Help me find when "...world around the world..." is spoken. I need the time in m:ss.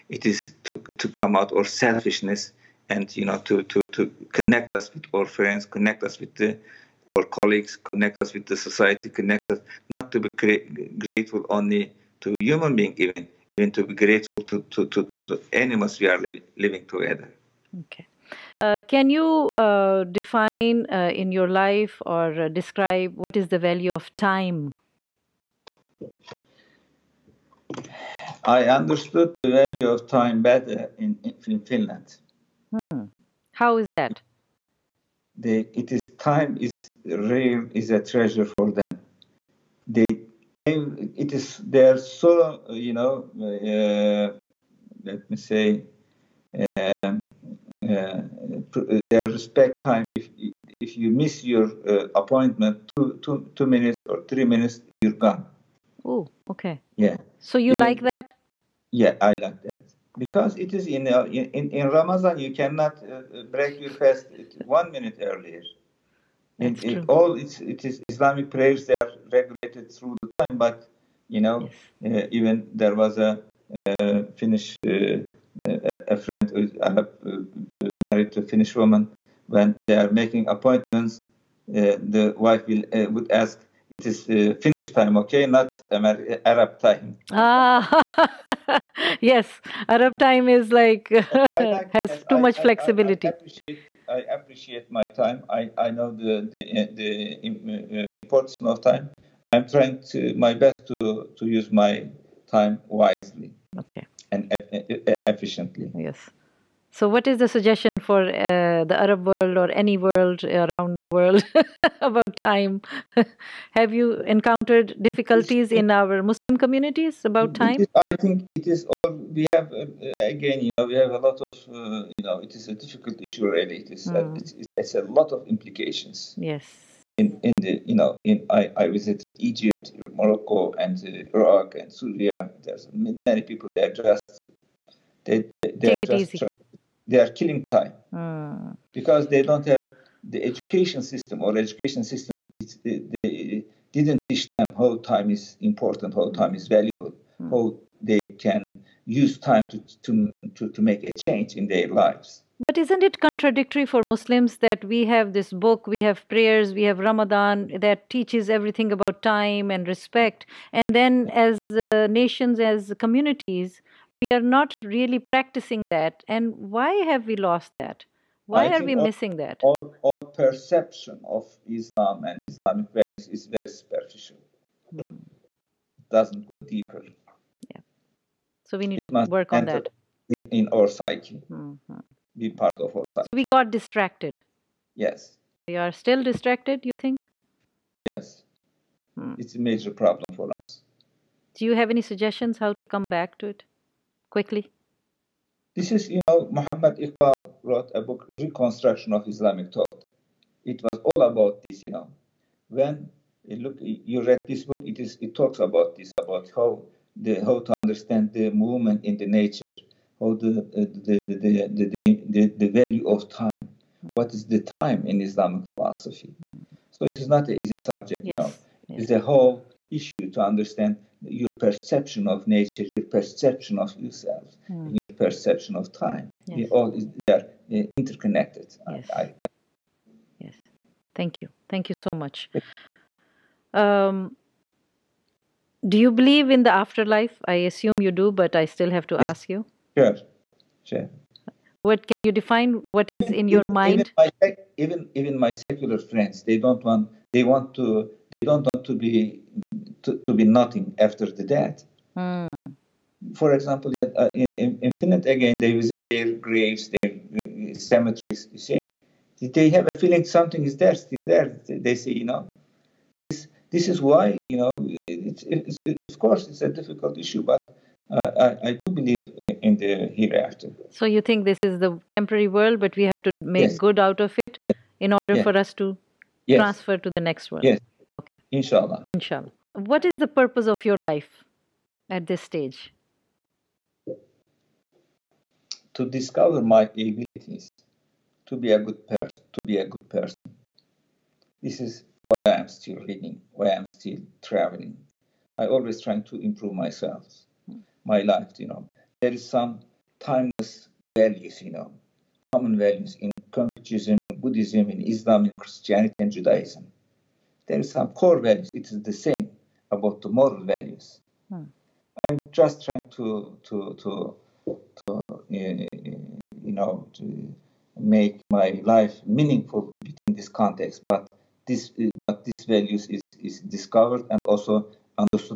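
1:50.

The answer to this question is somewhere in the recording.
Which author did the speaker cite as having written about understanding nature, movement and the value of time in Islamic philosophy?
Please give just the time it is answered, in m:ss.
3:16.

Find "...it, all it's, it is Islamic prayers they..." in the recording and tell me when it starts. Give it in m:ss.
1:06.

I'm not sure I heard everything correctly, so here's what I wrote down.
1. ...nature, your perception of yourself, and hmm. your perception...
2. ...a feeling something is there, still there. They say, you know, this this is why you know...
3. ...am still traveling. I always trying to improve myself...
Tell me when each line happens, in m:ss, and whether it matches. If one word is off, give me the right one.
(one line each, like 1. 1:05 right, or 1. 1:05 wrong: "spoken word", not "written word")
1. 3:42 right
2. 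4:19 right
3. 4:53 right.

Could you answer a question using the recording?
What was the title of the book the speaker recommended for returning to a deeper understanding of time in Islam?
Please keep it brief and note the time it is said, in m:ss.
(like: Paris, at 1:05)
Reconstruction of Islamic Thought, at 3:18.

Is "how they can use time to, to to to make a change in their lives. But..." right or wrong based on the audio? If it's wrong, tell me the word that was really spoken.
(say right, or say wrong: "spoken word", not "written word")
right.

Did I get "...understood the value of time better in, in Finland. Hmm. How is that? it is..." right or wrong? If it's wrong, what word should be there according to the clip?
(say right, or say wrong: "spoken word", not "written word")
right.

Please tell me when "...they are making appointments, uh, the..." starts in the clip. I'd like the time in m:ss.
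1:19.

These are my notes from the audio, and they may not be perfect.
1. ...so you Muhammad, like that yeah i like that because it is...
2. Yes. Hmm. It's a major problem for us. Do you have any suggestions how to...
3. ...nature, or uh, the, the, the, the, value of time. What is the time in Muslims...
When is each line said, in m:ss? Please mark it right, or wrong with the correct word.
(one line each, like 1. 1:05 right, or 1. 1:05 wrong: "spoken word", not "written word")
1. 0:57 wrong: "Even", not "Muhammad"
2. 3:07 right
3. 3:29 wrong: "Islamic", not "Muslims".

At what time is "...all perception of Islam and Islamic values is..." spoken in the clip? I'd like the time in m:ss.
2:50.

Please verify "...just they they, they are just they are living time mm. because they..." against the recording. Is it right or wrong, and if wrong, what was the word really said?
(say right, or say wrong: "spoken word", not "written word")
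wrong: "killing", not "living".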